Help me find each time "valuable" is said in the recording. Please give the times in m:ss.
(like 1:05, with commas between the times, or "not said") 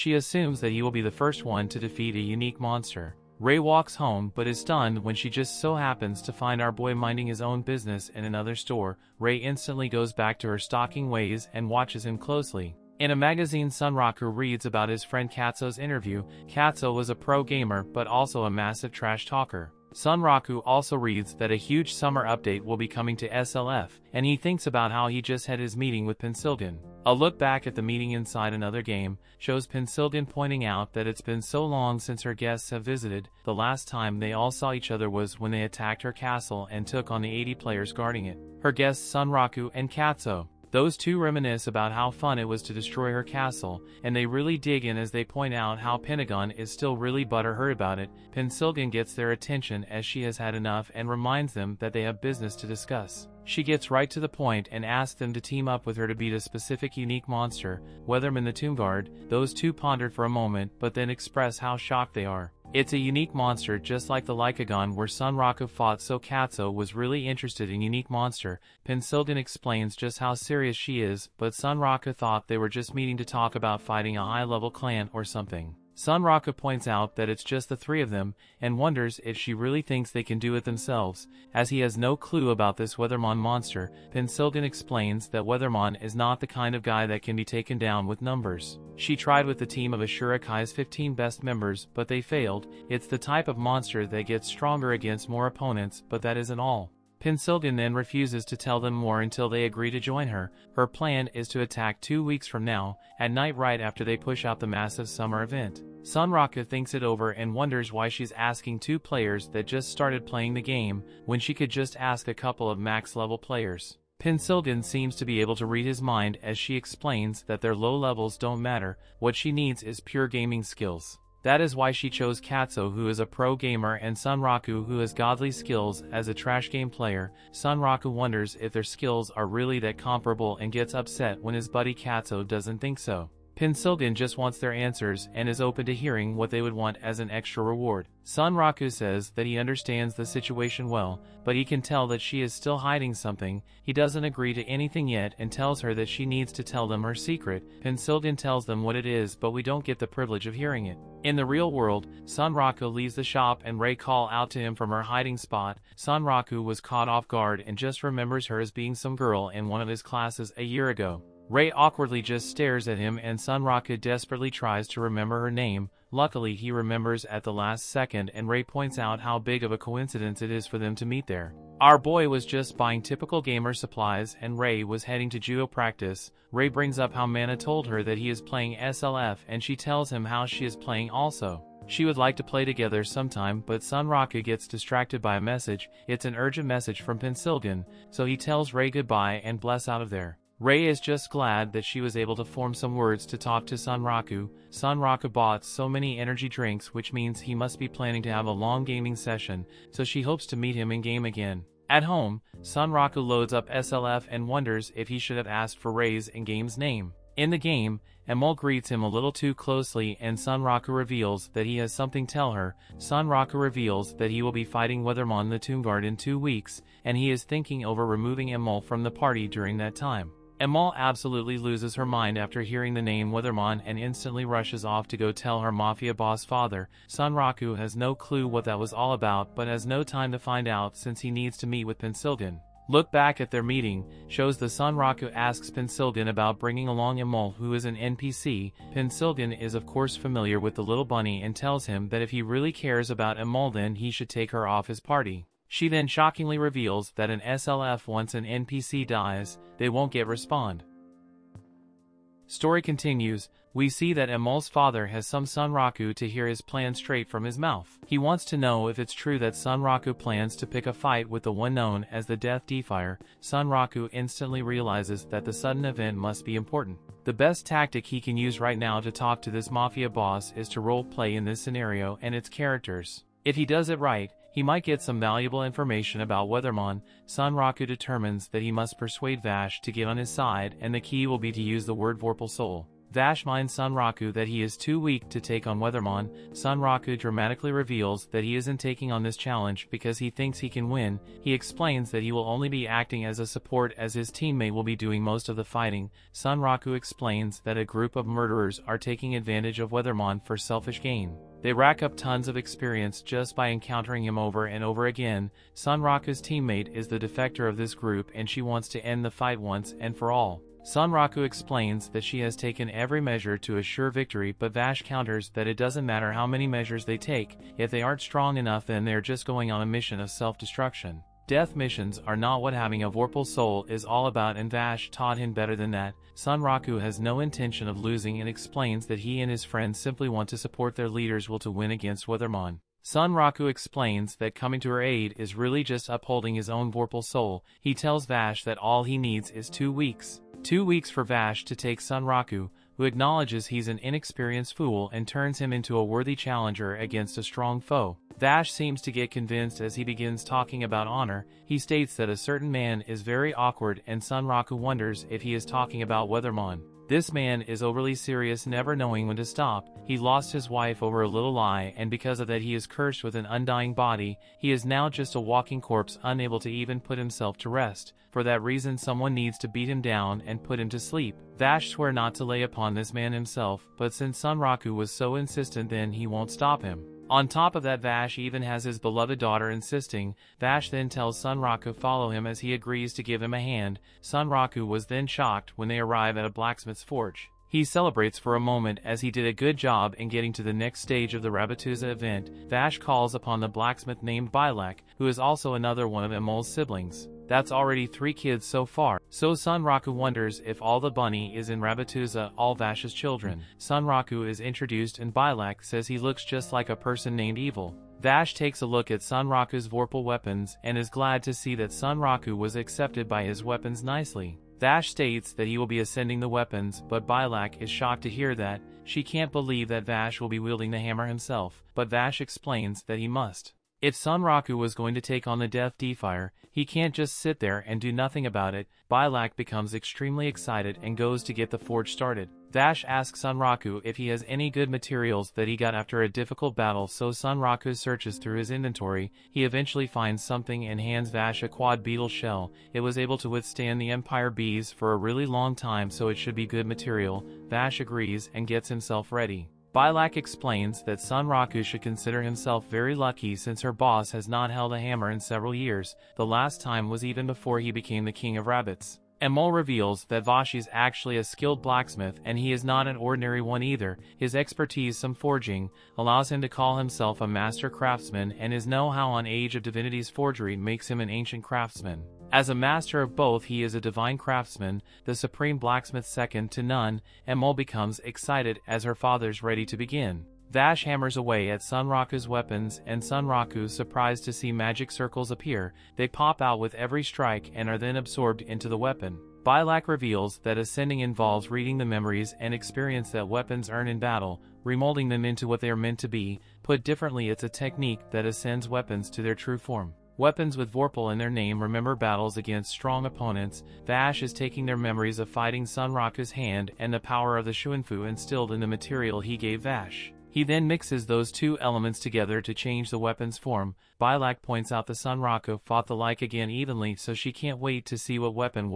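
4:35.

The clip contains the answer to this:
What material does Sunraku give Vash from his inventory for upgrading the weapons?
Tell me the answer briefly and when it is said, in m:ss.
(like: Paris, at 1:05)
Quad beetle shell, at 7:21.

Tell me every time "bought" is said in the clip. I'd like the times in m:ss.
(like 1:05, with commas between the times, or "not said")
3:15.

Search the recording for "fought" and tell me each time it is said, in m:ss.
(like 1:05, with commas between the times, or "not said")
1:05, 8:35.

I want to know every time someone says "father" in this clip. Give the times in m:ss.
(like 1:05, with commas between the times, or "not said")
3:46, 4:14, 7:59.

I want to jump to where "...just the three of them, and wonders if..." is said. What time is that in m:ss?
1:17.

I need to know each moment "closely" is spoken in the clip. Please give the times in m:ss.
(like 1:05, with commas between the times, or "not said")
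0:12, 3:29.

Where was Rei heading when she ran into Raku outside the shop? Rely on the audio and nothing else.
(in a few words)
Judo practice.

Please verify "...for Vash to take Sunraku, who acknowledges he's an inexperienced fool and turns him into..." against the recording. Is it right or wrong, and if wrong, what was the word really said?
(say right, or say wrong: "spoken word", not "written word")
right.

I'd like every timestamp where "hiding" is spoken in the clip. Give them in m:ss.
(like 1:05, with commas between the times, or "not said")
2:22, 2:35.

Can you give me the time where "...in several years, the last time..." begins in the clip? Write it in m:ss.
7:35.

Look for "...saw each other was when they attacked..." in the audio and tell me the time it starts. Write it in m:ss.
0:34.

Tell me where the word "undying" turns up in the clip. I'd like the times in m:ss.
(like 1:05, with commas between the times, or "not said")
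6:03.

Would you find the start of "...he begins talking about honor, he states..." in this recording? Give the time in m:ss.
5:49.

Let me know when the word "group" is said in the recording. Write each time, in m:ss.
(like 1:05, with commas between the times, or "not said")
4:57, 5:07.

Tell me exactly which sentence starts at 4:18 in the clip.
He wants to know if it's true that Sunraku plans to pick a fight with the one known as the Death Defier.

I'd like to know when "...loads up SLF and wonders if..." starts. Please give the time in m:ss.
3:23.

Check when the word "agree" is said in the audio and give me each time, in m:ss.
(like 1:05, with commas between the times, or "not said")
1:39, 2:24, 6:22, 7:27.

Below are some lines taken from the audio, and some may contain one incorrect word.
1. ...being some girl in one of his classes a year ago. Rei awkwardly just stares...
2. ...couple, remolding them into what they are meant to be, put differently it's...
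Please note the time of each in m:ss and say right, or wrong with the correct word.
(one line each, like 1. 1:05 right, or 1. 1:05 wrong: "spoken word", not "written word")
1. 2:38 right
2. 8:14 wrong: "battle", not "couple".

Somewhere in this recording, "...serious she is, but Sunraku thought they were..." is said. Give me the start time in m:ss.
1:10.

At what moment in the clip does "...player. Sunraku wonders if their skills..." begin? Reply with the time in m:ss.
2:06.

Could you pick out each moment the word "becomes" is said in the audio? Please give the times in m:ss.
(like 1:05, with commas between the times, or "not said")
7:09, 7:57.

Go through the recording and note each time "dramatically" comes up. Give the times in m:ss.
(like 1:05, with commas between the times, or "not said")
4:47.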